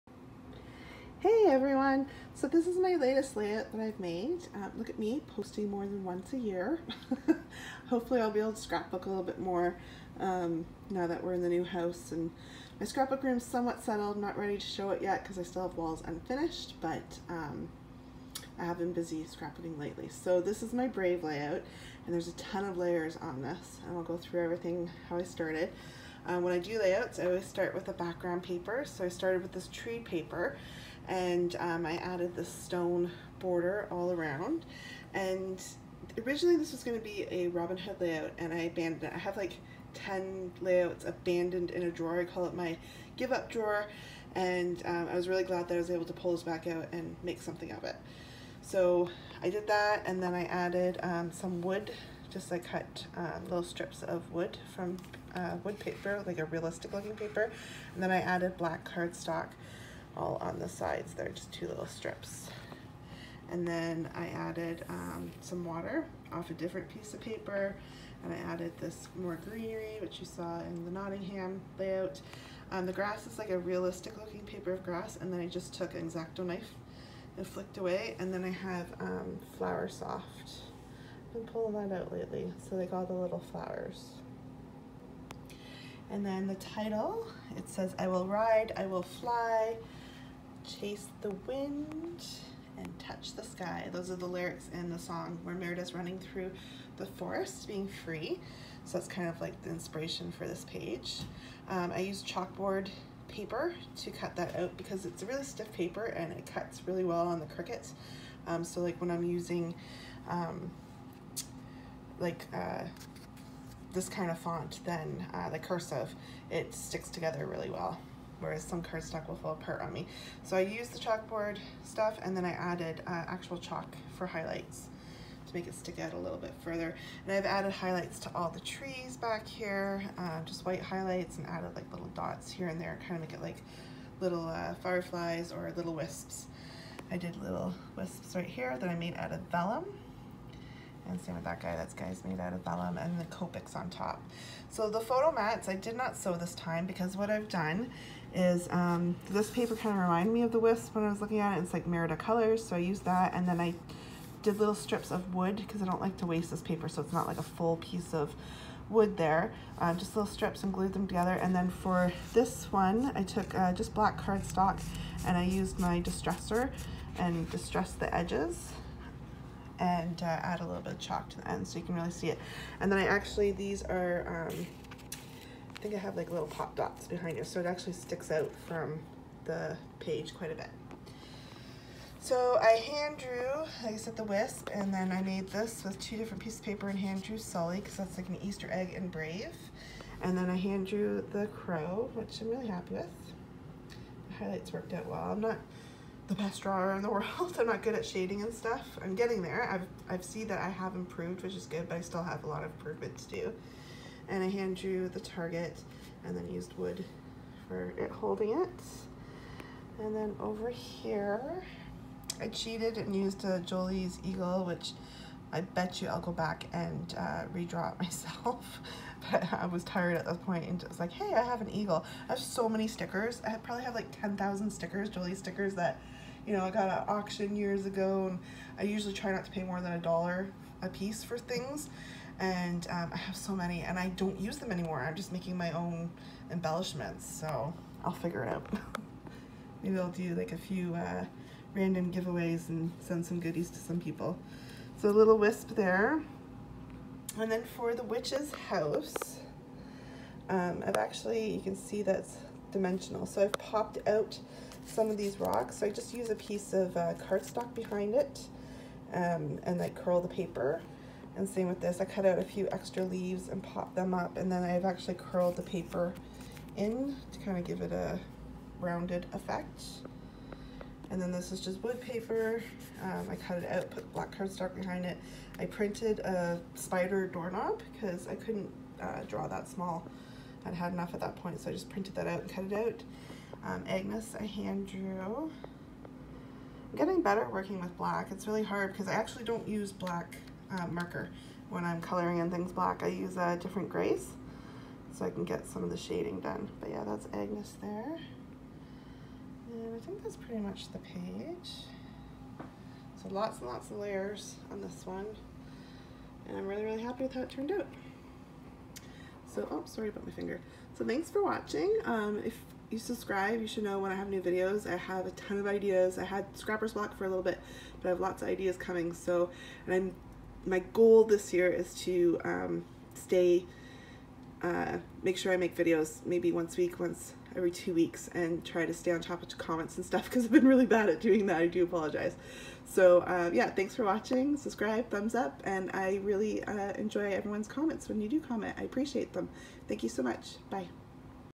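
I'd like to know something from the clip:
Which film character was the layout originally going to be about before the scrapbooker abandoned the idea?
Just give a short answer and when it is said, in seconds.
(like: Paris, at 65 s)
Robin Hood, at 37 s.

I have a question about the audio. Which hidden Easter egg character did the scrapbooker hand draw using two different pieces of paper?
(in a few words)
Sully.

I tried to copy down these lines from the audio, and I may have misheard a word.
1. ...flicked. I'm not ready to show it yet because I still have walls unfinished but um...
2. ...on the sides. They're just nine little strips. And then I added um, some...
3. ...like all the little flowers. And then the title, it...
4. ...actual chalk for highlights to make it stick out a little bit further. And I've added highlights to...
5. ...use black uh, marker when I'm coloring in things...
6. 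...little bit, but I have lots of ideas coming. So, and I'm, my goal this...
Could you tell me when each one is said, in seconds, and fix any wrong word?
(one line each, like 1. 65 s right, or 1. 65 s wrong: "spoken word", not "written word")
1. 13 s wrong: "settled", not "flicked"
2. 60 s wrong: "two", not "nine"
3. 82 s right
4. 123 s right
5. 289 s right
6. 317 s right.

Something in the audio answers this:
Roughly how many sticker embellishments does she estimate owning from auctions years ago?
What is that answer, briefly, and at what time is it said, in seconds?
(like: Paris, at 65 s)
10,000, at 224 s.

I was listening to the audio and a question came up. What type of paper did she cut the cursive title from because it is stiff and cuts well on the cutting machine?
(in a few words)
chalkboard paper.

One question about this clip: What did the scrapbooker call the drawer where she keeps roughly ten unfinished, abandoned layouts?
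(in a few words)
give up drawer.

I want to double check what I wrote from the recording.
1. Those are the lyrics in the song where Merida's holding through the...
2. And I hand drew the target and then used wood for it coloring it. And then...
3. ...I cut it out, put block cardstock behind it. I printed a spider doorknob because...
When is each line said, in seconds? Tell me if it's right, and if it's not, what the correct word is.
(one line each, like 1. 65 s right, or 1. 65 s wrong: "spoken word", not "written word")
1. 93 s wrong: "running", not "holding"
2. 204 s wrong: "holding", not "coloring"
3. 273 s wrong: "black", not "block".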